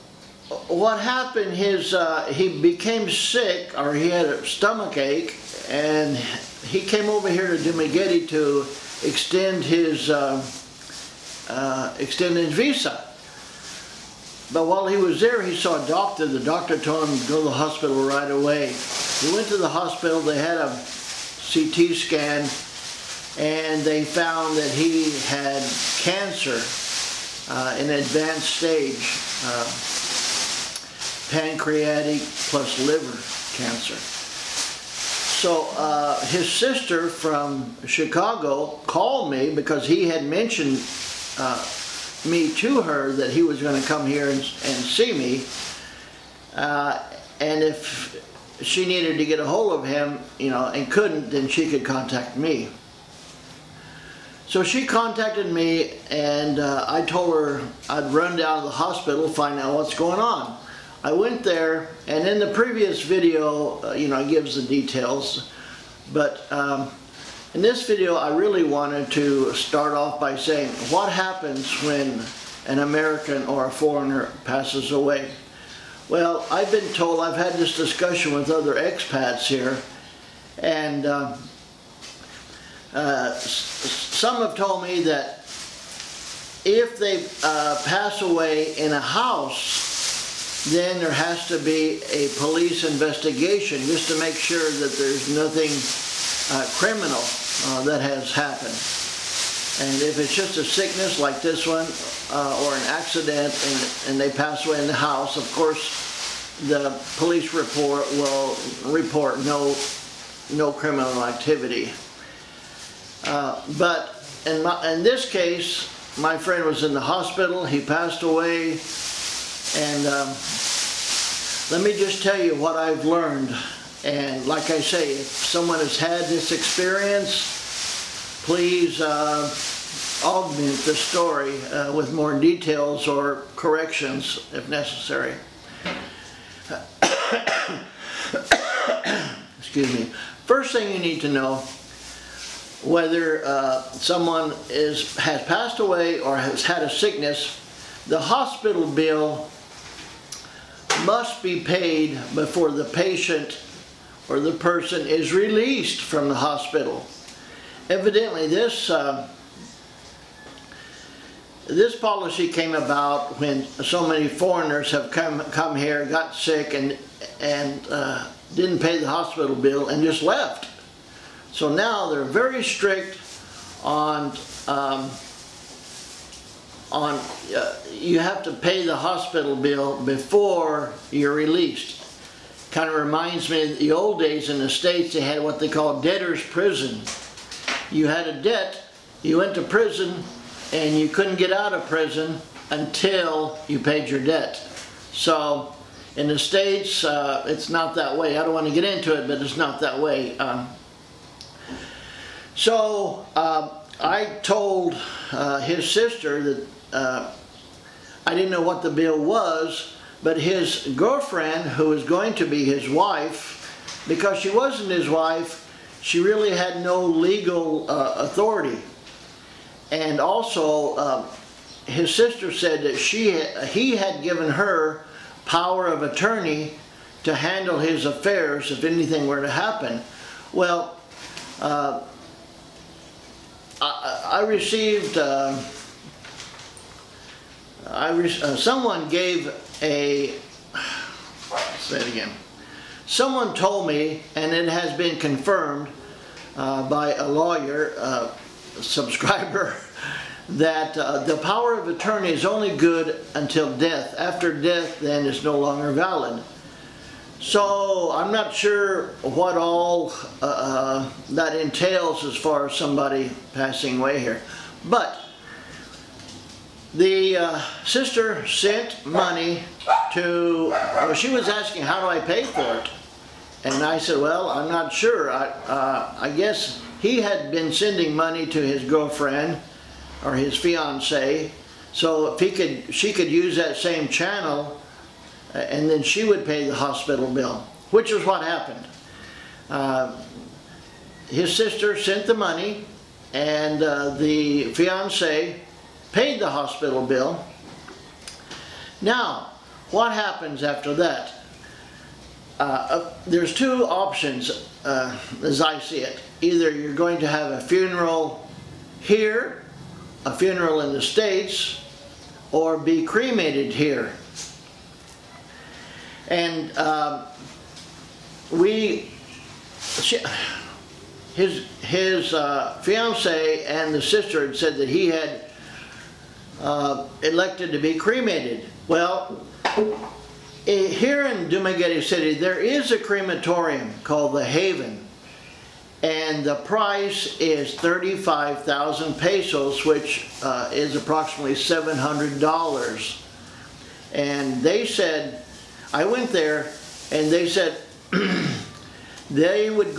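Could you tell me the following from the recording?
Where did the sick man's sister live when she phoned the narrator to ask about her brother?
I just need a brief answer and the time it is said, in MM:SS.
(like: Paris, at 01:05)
Chicago, at 00:37.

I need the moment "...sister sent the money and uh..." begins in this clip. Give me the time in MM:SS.
04:51.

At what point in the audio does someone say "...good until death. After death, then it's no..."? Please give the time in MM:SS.
04:12.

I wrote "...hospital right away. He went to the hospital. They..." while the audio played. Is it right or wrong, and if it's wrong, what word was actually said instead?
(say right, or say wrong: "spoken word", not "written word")
right.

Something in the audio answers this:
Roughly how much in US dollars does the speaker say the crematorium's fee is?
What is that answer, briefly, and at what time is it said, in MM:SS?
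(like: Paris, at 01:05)
$700, at 05:41.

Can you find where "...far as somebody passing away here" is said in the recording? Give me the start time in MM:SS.
04:22.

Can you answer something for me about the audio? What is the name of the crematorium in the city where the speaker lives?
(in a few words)
The Haven.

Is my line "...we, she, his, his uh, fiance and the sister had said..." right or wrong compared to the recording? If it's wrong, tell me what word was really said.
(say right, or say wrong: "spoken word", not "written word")
right.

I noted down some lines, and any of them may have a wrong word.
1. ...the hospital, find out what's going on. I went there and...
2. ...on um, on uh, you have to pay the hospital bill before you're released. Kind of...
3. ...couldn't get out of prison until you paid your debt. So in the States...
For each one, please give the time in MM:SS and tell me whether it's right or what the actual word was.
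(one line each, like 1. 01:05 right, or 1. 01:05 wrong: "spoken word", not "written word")
1. 00:58 right
2. 02:53 right
3. 03:11 right.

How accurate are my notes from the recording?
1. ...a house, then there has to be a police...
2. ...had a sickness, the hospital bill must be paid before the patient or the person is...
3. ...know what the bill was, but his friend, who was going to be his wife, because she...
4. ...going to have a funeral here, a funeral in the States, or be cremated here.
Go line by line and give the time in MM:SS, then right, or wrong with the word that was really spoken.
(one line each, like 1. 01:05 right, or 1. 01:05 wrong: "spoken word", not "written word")
1. 01:28 right
2. 02:26 right
3. 03:28 wrong: "girlfriend", not "friend"
4. 05:06 right.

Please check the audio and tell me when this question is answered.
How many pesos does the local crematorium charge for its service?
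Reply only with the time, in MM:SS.
05:37.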